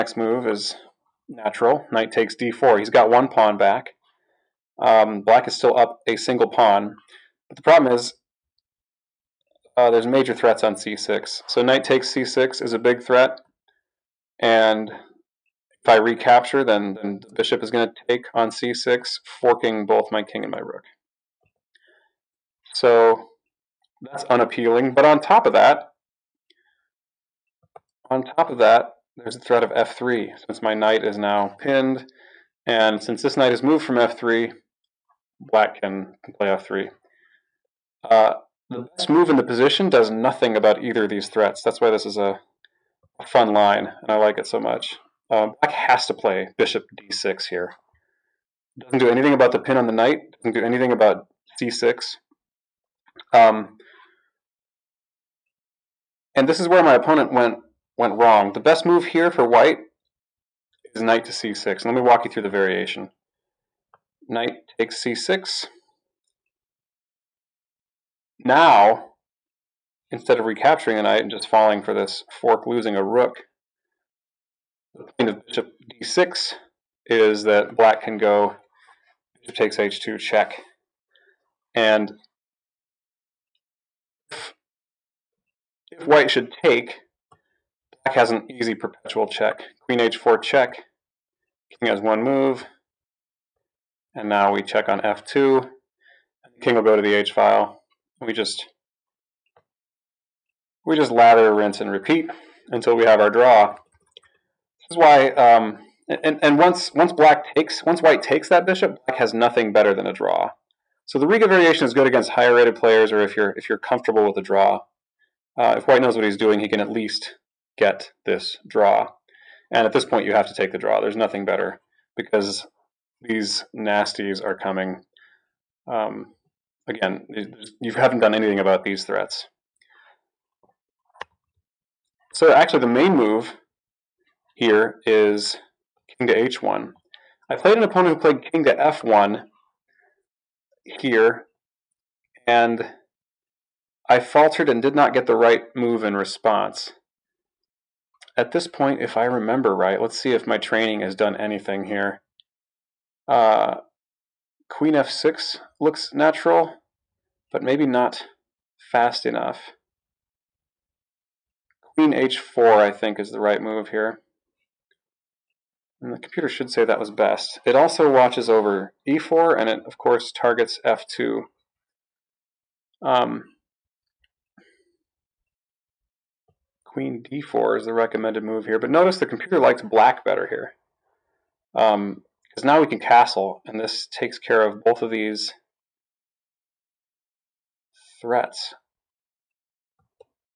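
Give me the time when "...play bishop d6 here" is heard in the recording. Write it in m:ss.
0:46.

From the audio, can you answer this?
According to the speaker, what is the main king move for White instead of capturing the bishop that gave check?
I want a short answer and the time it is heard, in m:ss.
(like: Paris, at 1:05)
King to h1, at 2:16.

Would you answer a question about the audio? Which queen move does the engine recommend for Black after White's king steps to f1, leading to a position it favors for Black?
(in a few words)
Queen d4.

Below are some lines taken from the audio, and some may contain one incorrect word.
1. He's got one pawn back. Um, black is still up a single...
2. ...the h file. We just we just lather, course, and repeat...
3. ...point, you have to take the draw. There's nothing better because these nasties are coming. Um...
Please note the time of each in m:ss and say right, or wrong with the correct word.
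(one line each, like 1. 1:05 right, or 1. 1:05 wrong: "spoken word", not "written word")
1. 0:02 right
2. 1:37 wrong: "rinse", not "course"
3. 2:00 right.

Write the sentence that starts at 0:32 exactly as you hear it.
And since this knight is moved from f3, black can play f3.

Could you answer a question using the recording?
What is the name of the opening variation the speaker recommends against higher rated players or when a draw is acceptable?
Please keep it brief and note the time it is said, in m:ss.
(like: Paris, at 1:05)
Riga variation, at 1:51.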